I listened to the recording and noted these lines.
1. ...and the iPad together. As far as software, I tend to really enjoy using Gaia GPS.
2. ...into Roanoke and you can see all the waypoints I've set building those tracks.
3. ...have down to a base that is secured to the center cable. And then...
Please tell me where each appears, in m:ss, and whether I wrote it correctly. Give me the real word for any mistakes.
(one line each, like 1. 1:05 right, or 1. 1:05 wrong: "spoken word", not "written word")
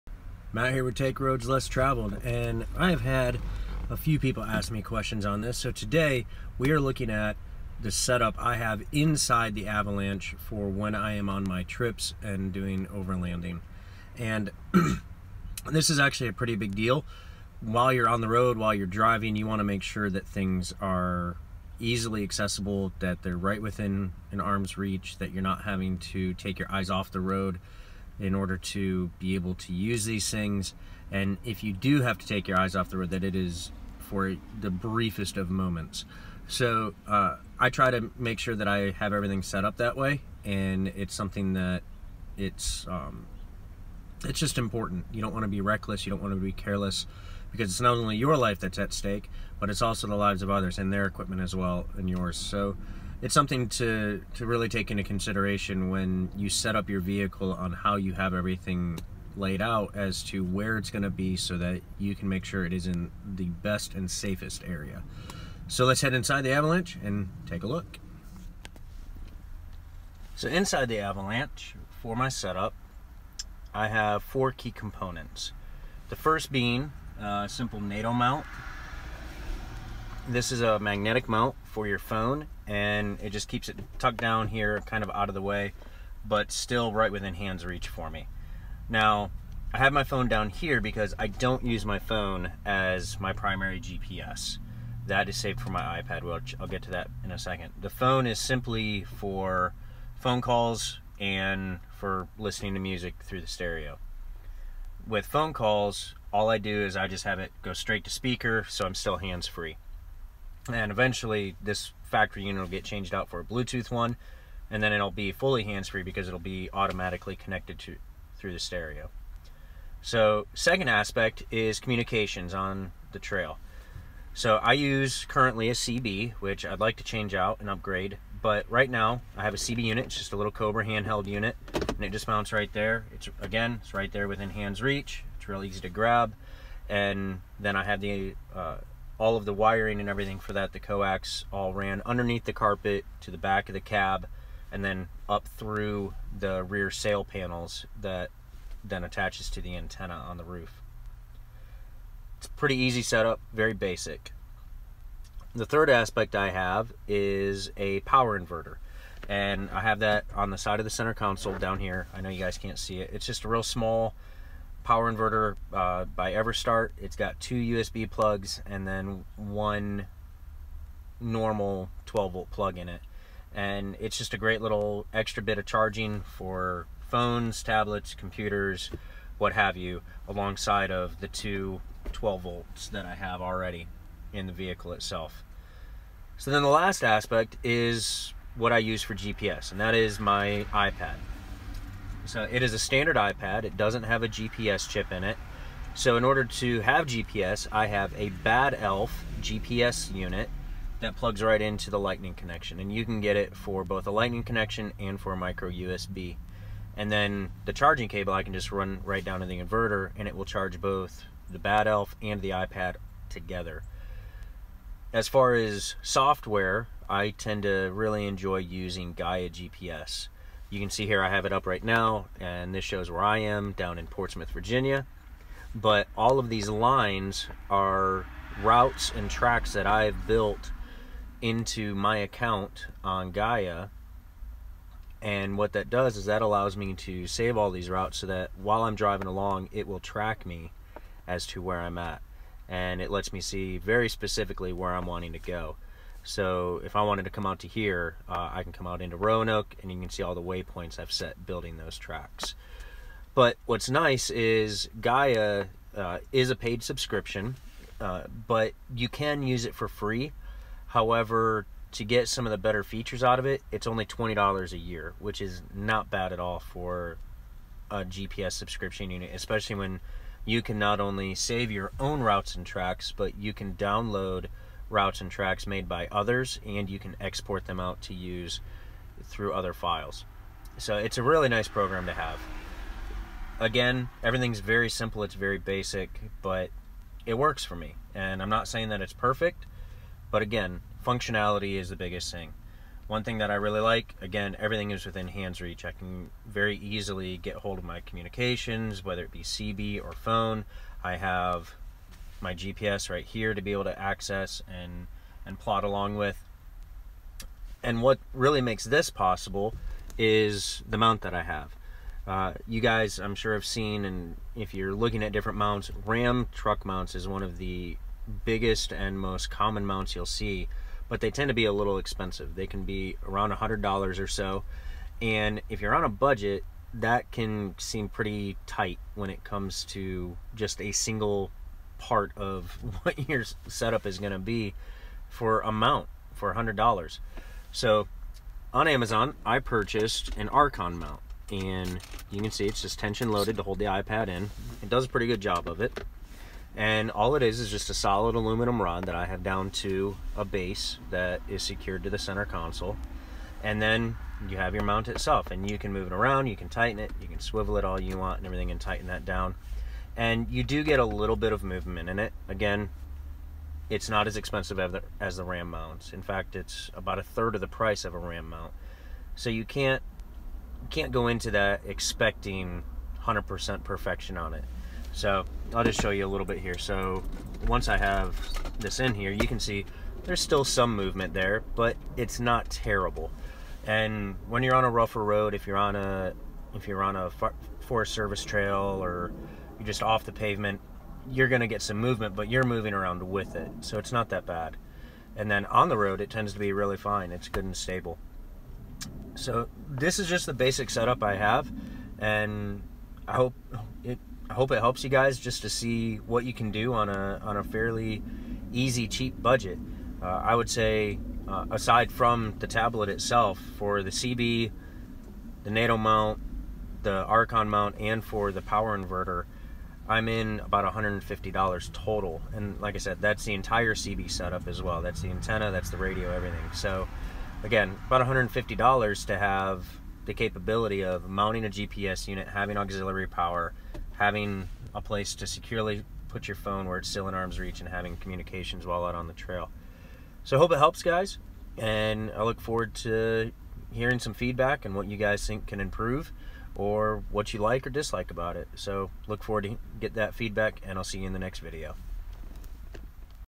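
1. 3:32 right
2. 4:09 right
3. 5:49 wrong: "console", not "cable".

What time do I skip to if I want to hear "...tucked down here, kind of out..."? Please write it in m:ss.
1:23.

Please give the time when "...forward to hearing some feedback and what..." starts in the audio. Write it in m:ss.
7:22.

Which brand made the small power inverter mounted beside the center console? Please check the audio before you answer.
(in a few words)
Everstart.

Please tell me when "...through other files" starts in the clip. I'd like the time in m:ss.
4:39.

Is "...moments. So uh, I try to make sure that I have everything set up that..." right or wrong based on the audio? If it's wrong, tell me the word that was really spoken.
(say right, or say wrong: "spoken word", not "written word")
right.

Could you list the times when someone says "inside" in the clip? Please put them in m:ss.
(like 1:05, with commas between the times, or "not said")
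0:08, 1:06, 1:10.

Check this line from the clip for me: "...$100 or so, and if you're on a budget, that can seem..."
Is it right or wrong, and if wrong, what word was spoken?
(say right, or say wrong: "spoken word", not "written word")
right.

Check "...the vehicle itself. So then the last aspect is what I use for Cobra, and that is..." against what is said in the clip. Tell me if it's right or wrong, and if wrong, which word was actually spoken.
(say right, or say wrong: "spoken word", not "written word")
wrong: "GPS", not "Cobra".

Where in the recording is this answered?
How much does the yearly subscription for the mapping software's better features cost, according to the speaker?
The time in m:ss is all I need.
4:24.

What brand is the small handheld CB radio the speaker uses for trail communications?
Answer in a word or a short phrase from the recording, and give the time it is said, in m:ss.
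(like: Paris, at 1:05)
Cobra, at 2:10.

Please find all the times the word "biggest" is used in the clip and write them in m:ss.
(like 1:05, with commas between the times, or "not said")
4:51, 5:18.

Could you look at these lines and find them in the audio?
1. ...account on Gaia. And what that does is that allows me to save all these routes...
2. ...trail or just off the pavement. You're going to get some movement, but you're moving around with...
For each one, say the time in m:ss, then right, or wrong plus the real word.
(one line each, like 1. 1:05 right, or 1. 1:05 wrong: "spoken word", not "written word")
1. 3:52 right
2. 6:28 right.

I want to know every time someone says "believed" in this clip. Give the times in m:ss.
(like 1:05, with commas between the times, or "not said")
not said.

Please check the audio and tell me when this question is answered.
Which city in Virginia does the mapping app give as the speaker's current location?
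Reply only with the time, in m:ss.
3:44.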